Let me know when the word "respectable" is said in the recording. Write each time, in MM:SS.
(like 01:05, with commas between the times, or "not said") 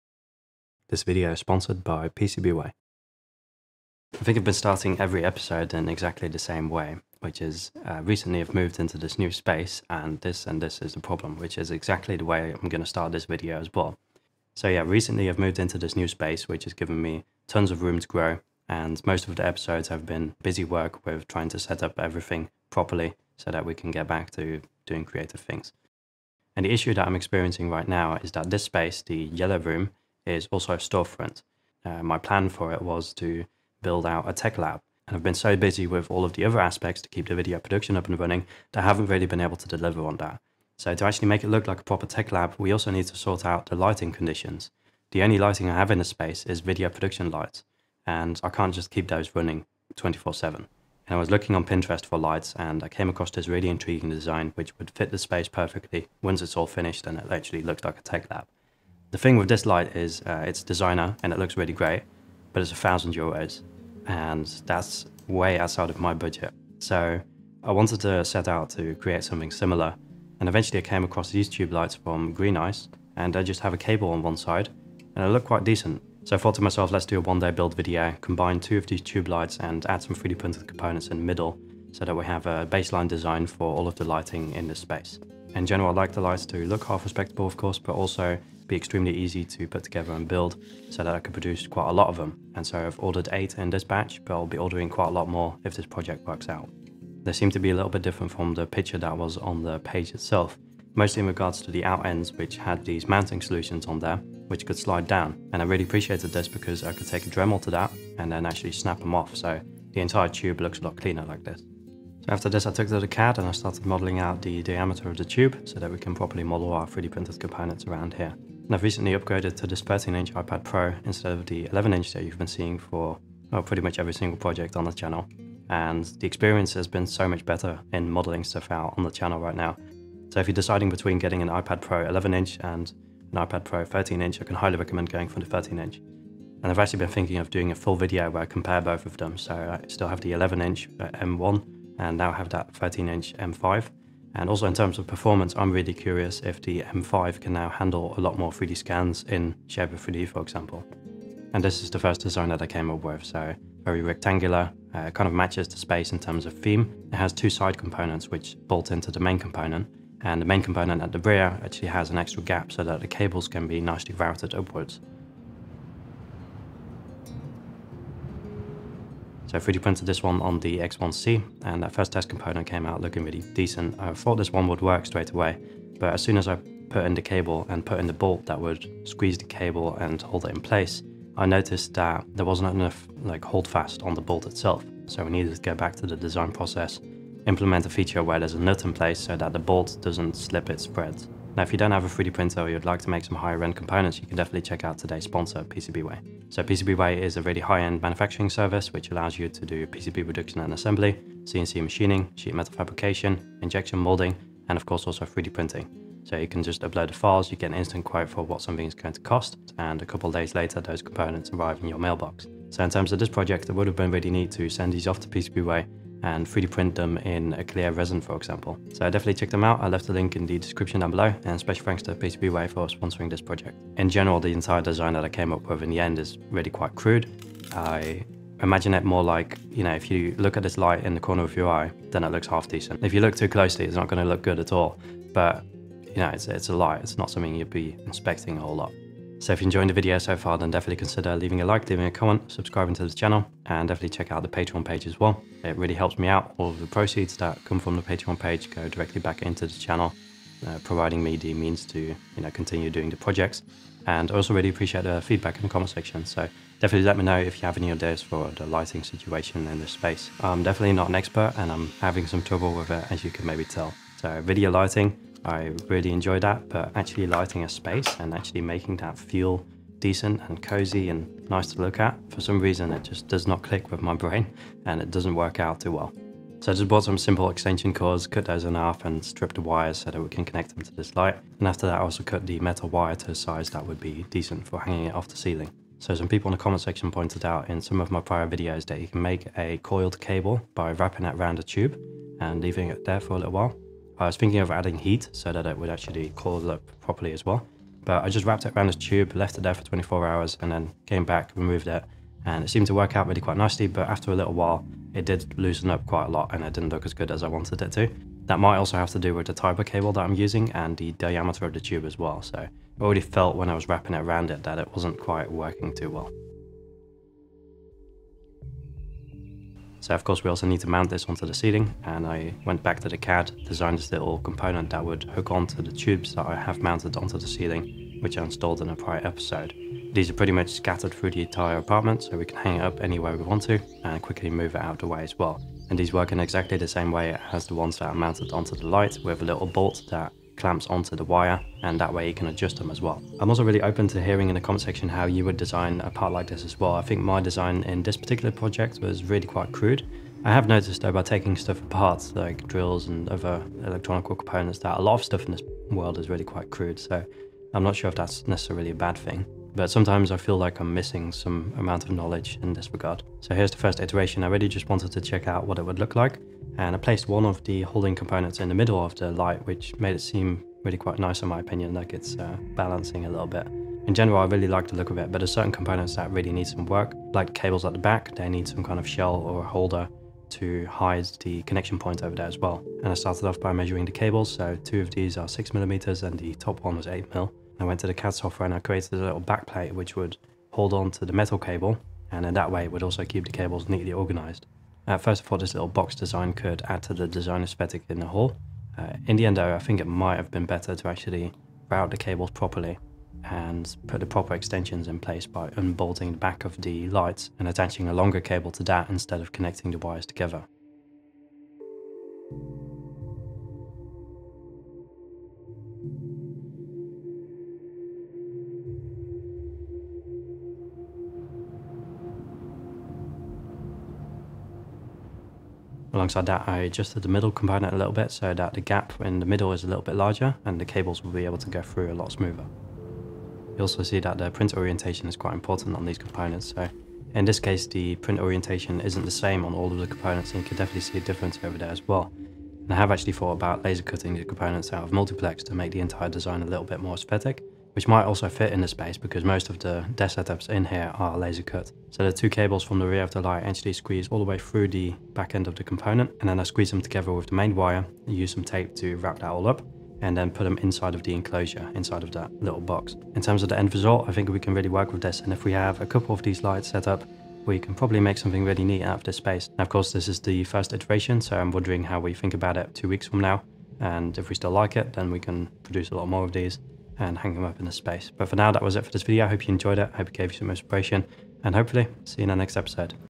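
01:27.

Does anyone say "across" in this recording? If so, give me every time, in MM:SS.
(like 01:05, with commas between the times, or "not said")
00:53, 01:11.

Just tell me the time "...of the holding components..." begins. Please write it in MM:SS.
06:07.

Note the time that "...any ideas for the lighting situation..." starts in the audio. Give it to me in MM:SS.
04:17.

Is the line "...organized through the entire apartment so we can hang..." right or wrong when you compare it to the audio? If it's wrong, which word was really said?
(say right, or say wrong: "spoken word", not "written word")
wrong: "scattered", not "organized".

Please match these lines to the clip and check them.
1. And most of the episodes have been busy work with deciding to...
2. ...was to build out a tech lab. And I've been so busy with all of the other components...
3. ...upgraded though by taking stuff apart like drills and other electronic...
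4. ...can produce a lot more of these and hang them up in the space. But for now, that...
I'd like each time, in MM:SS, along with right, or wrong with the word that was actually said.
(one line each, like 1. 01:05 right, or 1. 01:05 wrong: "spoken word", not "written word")
1. 00:18 wrong: "trying", not "deciding"
2. 00:32 wrong: "aspects", not "components"
3. 05:50 wrong: "noticed", not "upgraded"
4. 07:55 right.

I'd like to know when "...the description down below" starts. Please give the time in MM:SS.
03:40.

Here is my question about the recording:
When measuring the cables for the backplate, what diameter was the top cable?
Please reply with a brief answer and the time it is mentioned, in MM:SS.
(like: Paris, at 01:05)
8mm, at 06:27.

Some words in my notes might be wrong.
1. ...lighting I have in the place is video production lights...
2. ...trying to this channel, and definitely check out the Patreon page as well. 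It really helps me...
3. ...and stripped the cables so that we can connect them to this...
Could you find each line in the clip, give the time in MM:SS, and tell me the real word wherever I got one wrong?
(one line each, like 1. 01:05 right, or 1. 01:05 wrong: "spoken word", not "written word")
1. 00:45 wrong: "space", not "place"
2. 04:02 wrong: "subscribing", not "trying"
3. 04:39 wrong: "wires", not "cables".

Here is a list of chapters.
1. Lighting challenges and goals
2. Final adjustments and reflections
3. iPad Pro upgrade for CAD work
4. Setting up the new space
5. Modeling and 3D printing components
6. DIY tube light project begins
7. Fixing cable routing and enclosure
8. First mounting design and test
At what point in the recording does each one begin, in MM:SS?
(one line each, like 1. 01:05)
1. 01:00
2. 07:44
3. 04:38
4. 00:11
5. 03:12
6. 02:00
7. 06:33
8. 05:35.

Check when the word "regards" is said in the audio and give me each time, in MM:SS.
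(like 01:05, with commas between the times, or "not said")
01:41, 06:02.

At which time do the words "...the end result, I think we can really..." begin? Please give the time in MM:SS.
07:43.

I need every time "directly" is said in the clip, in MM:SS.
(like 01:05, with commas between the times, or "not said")
04:08.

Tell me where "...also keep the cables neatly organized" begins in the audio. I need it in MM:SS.
06:33.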